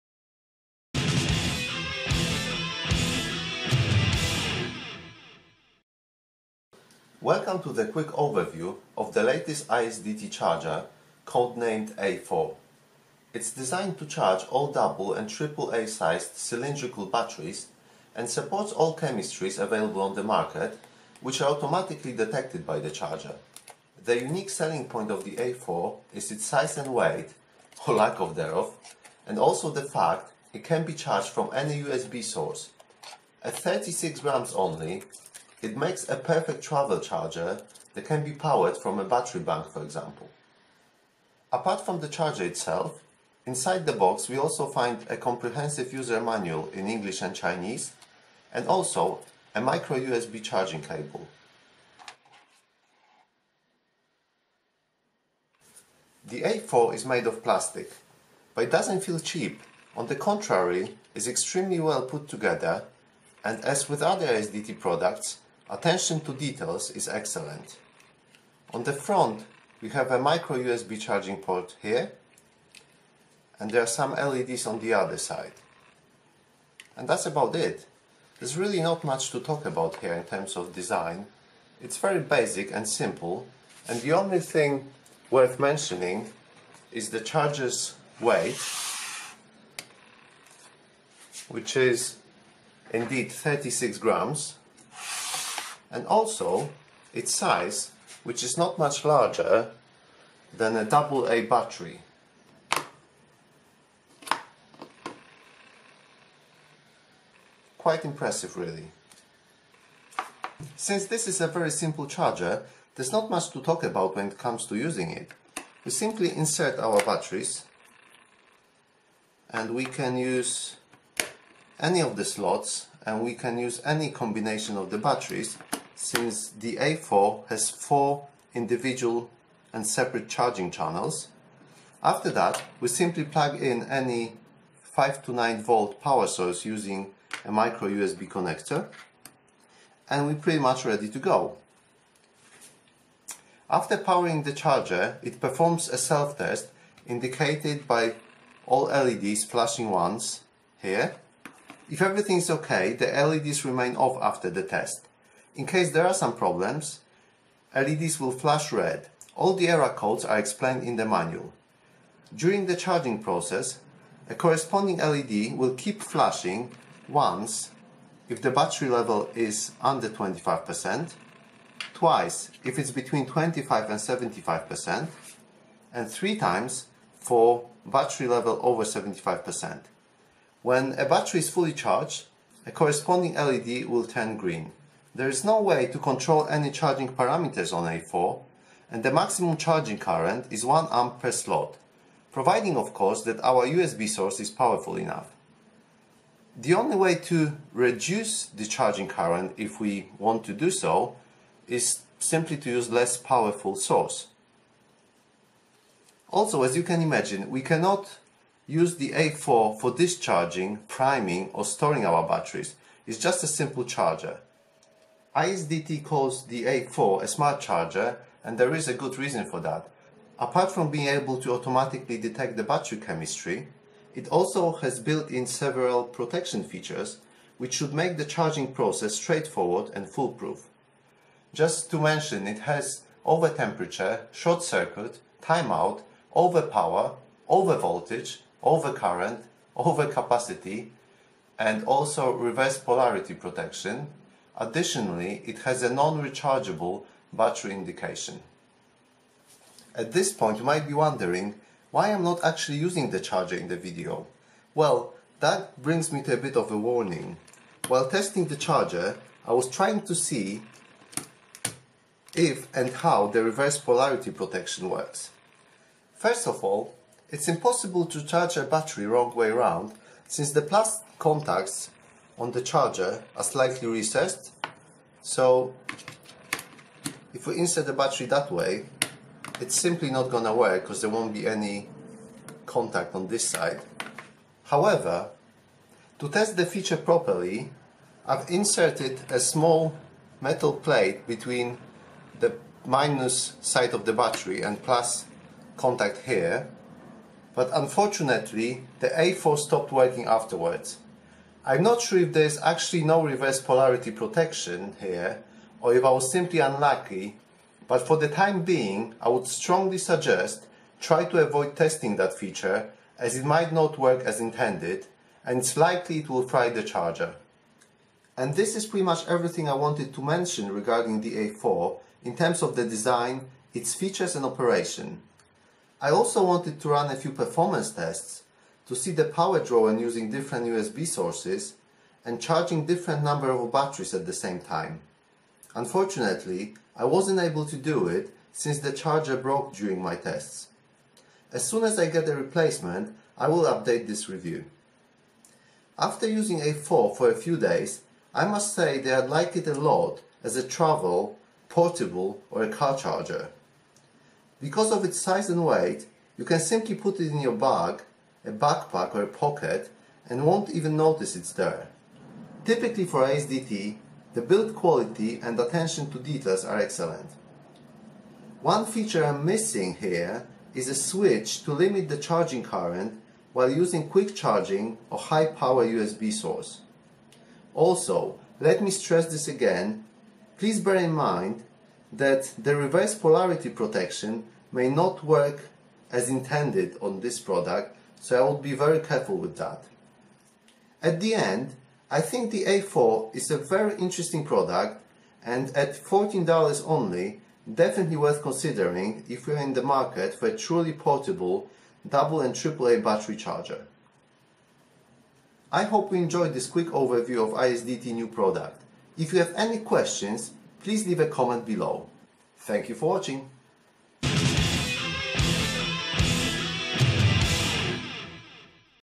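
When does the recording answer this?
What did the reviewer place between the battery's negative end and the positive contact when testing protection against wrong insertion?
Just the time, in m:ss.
4:49.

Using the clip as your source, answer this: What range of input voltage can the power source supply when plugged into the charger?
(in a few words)
5 to 9 volt.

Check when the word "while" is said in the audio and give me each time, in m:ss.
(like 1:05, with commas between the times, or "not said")
4:17, 6:13.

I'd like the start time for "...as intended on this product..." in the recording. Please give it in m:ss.
6:26.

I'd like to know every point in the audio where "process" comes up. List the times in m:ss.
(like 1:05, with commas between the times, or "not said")
2:43, 3:48.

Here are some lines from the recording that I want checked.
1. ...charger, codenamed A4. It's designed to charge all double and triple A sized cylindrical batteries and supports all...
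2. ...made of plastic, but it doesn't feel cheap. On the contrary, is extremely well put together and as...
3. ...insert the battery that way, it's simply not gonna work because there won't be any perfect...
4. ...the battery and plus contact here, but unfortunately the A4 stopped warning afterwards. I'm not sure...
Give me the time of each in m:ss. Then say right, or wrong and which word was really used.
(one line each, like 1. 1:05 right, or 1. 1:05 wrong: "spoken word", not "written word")
1. 0:10 right
2. 0:57 right
3. 4:37 wrong: "contact", not "perfect"
4. 4:54 wrong: "working", not "warning".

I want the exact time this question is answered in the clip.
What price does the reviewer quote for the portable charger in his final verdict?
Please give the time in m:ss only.
6:35.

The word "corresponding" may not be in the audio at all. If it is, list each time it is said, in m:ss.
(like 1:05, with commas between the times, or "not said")
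2:44, 3:02.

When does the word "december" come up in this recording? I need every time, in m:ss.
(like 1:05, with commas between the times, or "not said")
not said.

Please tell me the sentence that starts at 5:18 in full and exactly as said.
And this is pretty much everything I wanted to mention regarding the A4 in terms of the design, its features and operation.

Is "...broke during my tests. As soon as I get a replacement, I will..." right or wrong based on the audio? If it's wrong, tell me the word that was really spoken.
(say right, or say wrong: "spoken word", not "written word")
right.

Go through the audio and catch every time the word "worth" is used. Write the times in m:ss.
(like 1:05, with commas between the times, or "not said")
1:25, 6:38.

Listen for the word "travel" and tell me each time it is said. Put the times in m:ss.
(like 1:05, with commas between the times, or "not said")
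0:36, 5:50.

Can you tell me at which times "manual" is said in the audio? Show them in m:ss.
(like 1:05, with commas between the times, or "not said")
0:46, 2:41.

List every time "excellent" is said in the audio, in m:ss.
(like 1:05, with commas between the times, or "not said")
1:07, 6:06.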